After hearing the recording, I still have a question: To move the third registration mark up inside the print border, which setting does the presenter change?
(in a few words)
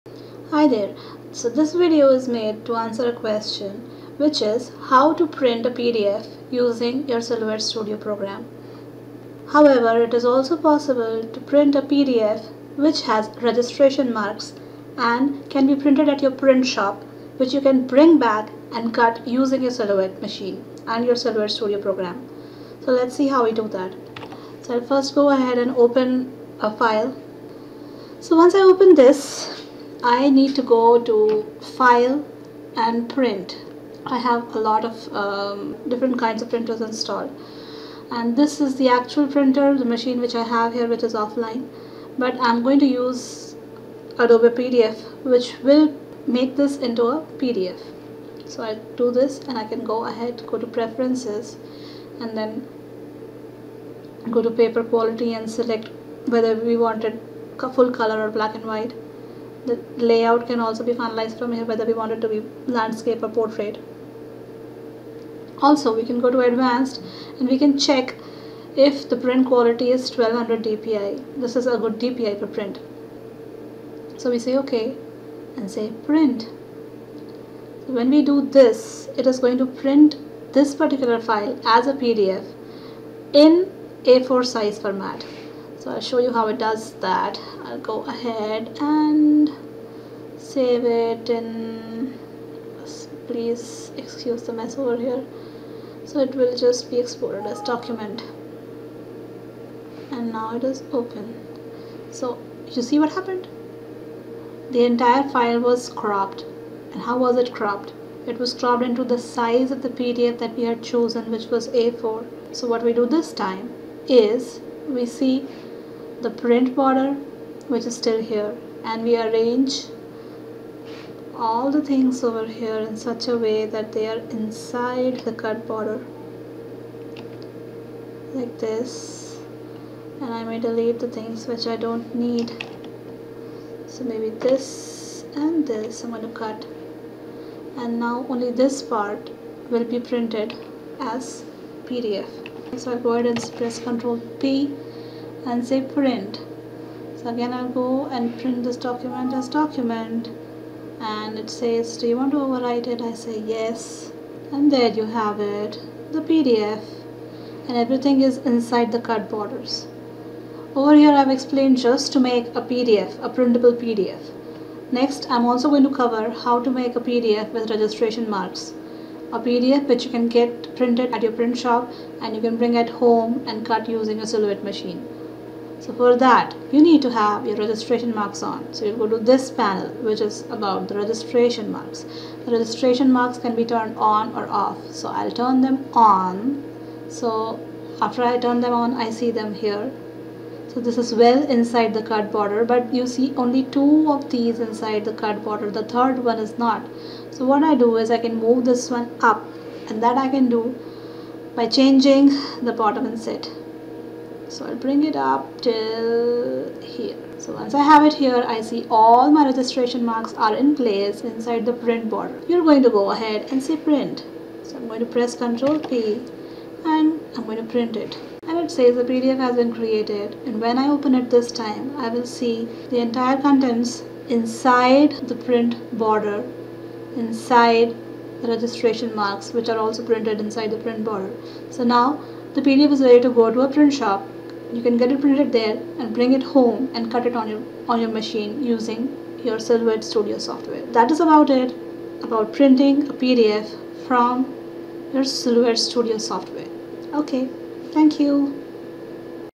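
bottom inset.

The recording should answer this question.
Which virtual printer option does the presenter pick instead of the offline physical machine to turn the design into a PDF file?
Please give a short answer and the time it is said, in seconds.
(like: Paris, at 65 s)
Adobe PDF, at 44 s.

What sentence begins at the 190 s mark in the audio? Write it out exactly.
So this is well inside the card border but you see only two of these inside the card border.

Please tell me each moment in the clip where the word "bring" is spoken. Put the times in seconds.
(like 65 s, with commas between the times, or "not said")
17 s, 172 s, 204 s, 236 s.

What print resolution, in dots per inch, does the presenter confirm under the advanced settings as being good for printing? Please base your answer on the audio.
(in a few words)
1200.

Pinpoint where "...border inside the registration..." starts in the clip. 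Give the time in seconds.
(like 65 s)
225 s.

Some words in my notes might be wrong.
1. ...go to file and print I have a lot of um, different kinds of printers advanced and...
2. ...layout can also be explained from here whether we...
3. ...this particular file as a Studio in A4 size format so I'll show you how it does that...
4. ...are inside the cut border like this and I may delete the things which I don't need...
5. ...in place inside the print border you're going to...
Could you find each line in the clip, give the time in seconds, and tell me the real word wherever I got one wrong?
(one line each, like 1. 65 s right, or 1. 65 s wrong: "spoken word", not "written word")
1. 30 s wrong: "installed", not "advanced"
2. 59 s wrong: "finalized", not "explained"
3. 80 s wrong: "PDF", not "Studio"
4. 124 s right
5. 210 s right.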